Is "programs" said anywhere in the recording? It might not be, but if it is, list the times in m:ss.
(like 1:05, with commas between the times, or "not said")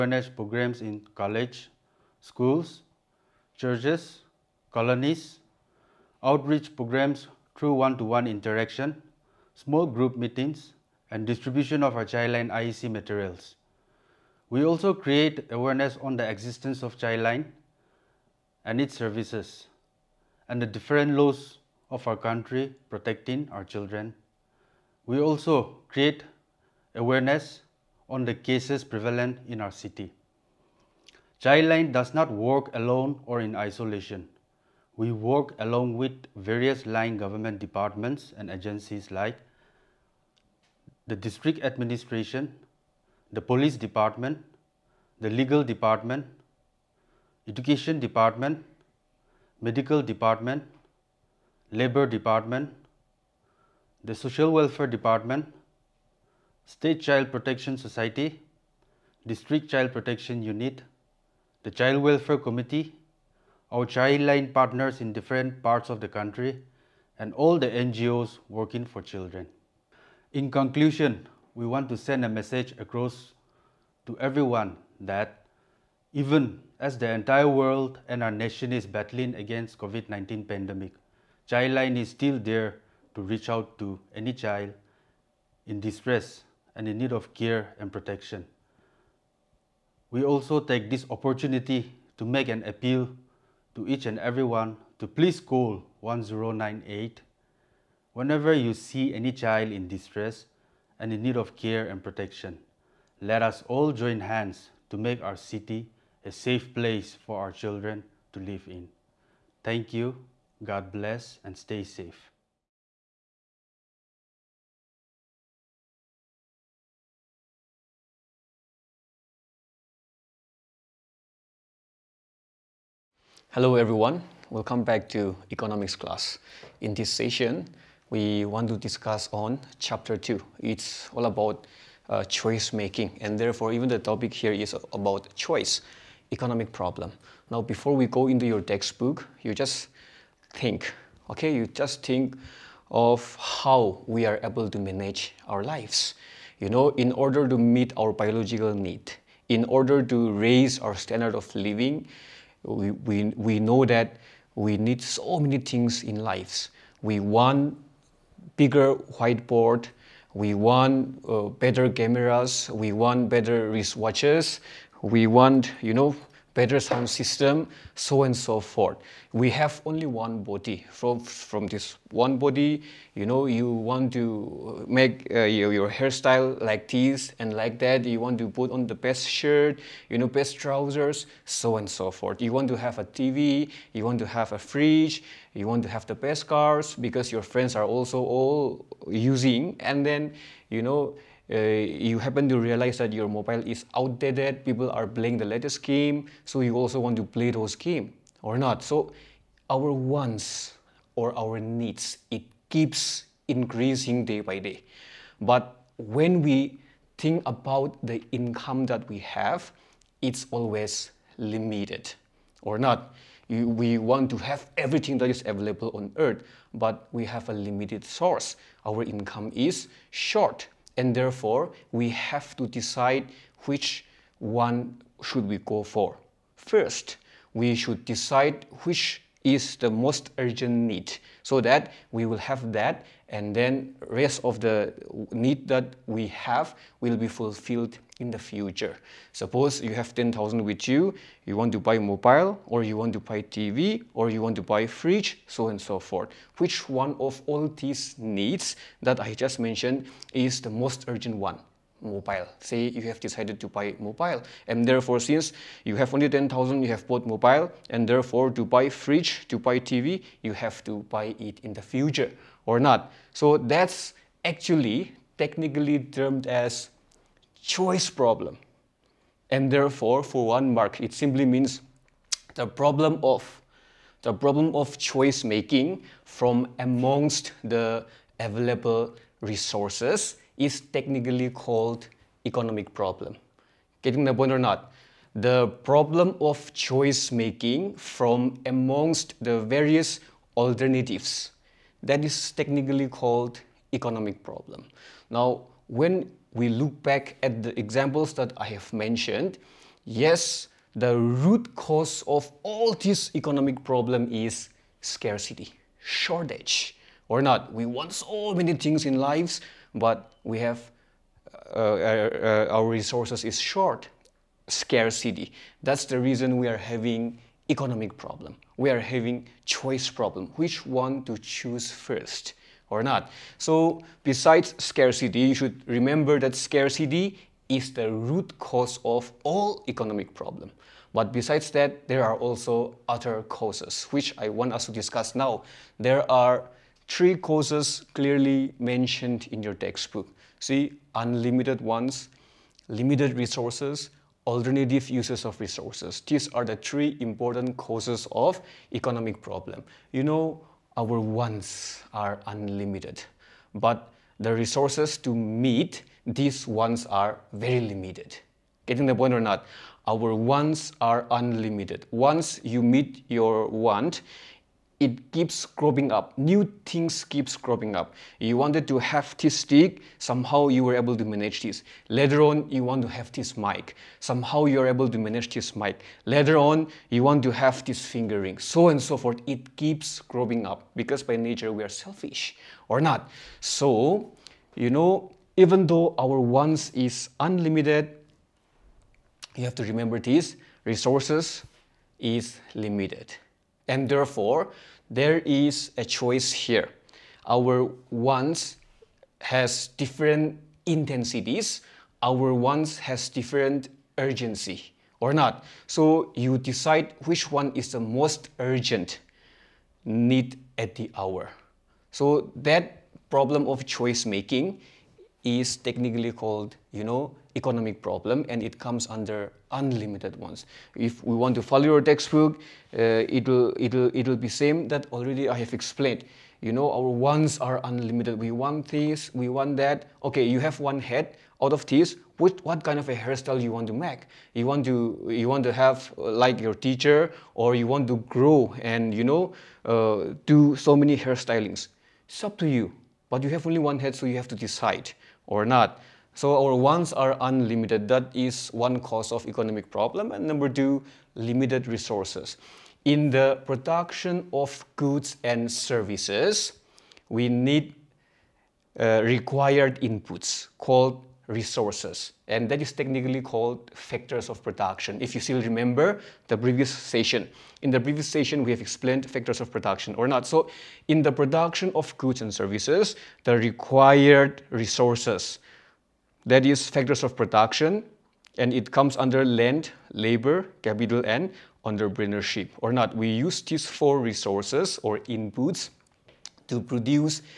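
0:00, 0:06.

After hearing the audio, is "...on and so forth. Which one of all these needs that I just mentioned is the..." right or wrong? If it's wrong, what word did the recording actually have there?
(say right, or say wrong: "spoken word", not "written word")
right.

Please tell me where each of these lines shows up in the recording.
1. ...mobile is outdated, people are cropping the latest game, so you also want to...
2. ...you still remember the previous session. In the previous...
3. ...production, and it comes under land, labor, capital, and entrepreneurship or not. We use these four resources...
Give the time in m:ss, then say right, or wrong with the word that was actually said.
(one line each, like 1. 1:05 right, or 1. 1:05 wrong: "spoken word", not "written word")
1. 3:13 wrong: "playing", not "cropping"
2. 7:45 right
3. 7:57 right.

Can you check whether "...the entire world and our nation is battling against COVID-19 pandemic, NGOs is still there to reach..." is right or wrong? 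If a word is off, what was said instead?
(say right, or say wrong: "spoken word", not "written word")
wrong: "Childline", not "NGOs".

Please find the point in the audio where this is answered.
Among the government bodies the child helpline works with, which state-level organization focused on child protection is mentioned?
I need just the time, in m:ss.
0:56.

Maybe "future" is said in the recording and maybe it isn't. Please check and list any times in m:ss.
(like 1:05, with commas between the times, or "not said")
3:58, 4:21.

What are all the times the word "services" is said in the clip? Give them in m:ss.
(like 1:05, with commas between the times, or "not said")
0:18, 7:35, 7:52.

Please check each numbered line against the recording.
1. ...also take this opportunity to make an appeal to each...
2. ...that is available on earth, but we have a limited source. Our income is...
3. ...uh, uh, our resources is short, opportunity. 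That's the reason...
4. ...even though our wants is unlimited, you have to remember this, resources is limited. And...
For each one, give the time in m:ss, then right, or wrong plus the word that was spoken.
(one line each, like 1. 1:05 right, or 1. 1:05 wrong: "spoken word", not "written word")
1. 1:30 right
2. 3:35 right
3. 5:11 wrong: "scarcity", not "opportunity"
4. 6:25 right.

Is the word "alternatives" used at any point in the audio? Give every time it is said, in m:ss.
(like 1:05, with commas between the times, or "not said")
4:50, 5:44.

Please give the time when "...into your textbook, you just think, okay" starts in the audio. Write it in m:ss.
2:18.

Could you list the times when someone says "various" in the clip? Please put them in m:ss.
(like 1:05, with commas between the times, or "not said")
0:36, 4:49.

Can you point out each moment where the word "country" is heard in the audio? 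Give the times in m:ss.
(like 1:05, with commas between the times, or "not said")
0:22, 1:06.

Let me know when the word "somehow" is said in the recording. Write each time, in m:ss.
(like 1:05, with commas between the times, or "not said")
6:10, 6:14.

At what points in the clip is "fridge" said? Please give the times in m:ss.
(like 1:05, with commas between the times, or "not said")
3:04, 4:04, 4:18.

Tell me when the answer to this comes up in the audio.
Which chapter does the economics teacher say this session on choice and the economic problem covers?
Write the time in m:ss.
2:09.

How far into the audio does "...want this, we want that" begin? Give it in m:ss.
7:08.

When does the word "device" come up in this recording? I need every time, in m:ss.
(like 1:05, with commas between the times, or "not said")
not said.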